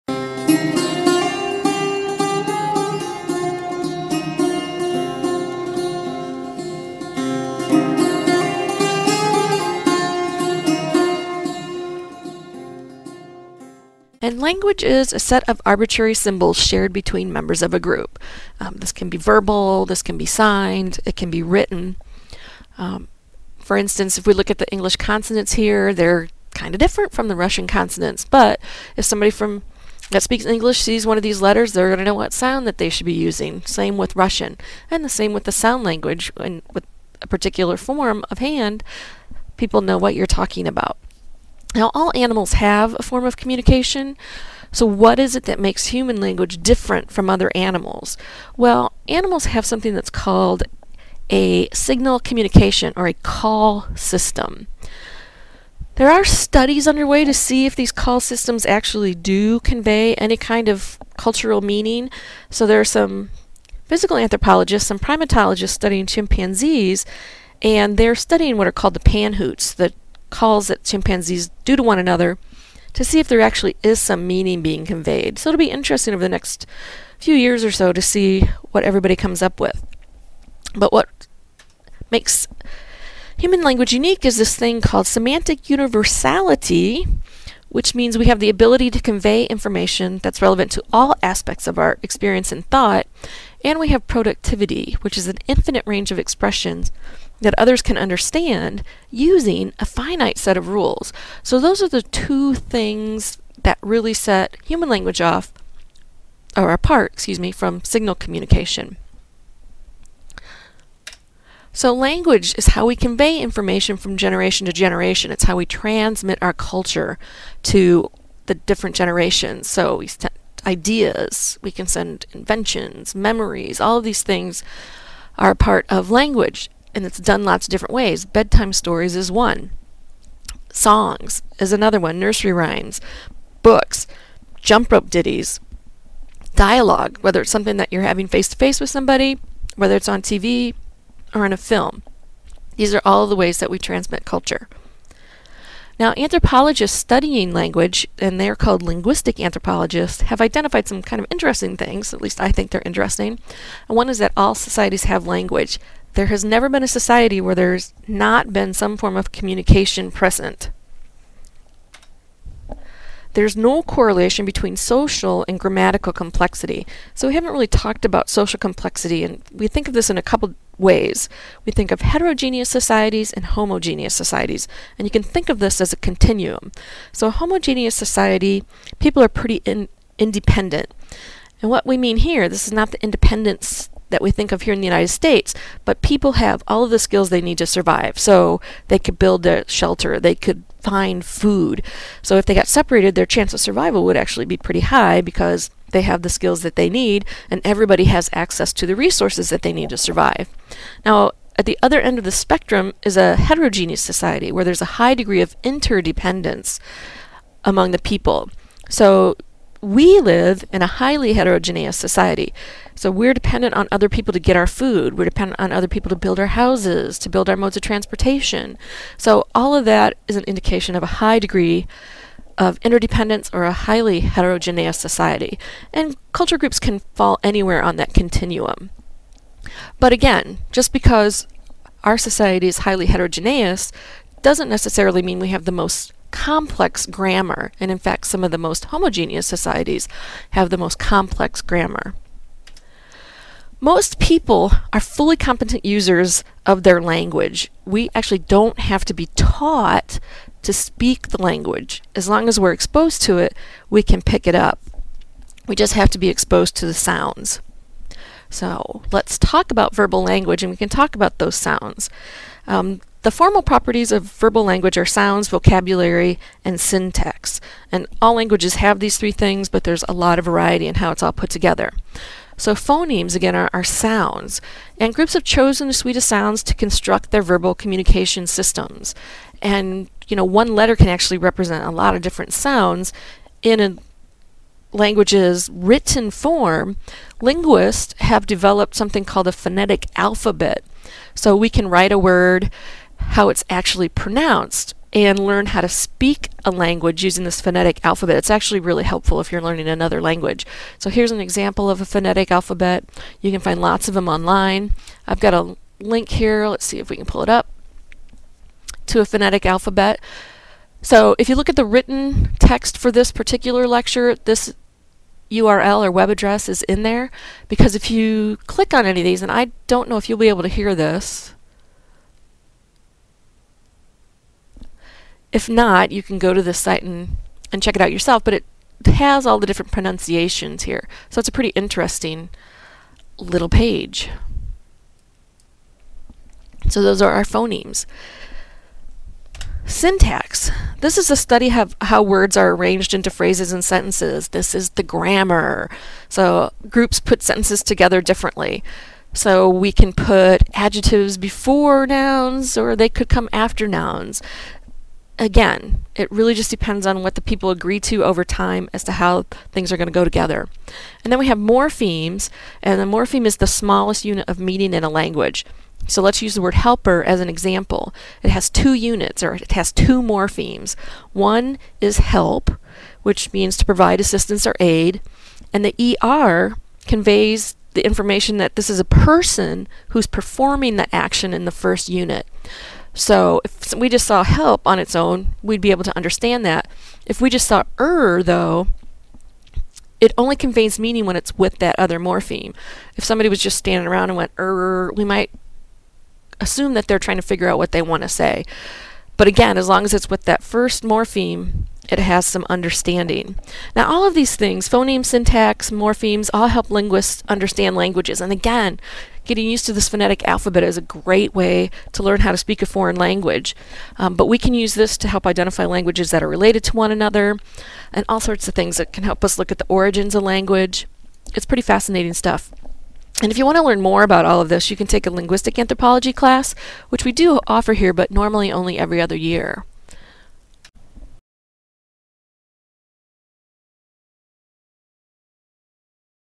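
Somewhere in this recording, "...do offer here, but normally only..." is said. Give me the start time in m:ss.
7:07.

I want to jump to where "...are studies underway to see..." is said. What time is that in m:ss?
0:56.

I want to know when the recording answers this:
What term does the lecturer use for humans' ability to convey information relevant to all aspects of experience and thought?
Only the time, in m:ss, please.
1:25.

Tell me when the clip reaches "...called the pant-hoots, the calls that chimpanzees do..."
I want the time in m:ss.
1:08.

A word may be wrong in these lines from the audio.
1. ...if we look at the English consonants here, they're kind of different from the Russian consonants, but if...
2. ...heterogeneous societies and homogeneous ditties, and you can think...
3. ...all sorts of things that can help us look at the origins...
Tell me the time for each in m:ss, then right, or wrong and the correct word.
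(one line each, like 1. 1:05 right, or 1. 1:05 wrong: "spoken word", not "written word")
1. 0:24 right
2. 2:52 wrong: "societies", not "ditties"
3. 6:58 right.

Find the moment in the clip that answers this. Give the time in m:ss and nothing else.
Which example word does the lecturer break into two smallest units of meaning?
6:06.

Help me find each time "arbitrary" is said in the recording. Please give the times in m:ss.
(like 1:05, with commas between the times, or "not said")
0:15.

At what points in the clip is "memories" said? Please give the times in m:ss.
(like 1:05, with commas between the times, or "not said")
2:03.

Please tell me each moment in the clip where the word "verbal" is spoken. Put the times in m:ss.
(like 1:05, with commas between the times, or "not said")
0:19, 4:19, 4:24, 4:37.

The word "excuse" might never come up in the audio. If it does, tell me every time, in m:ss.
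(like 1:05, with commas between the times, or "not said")
1:47.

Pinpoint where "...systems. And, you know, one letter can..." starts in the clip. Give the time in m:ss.
4:38.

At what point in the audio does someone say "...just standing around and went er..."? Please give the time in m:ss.
6:33.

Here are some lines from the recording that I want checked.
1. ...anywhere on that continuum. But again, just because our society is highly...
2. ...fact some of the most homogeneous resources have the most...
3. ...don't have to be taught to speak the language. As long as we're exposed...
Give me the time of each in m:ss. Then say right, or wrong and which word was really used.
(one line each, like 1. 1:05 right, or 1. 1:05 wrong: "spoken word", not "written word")
1. 3:47 right
2. 3:57 wrong: "societies", not "resources"
3. 4:08 right.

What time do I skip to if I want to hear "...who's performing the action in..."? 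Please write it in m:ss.
6:20.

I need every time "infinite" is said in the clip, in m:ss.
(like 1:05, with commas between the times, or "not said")
1:35.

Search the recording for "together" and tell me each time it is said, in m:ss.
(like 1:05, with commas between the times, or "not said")
4:31, 5:47, 6:00.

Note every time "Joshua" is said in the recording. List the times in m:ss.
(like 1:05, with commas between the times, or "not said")
not said.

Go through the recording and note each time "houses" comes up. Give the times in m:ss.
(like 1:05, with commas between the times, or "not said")
3:36.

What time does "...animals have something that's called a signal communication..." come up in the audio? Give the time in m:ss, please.
0:49.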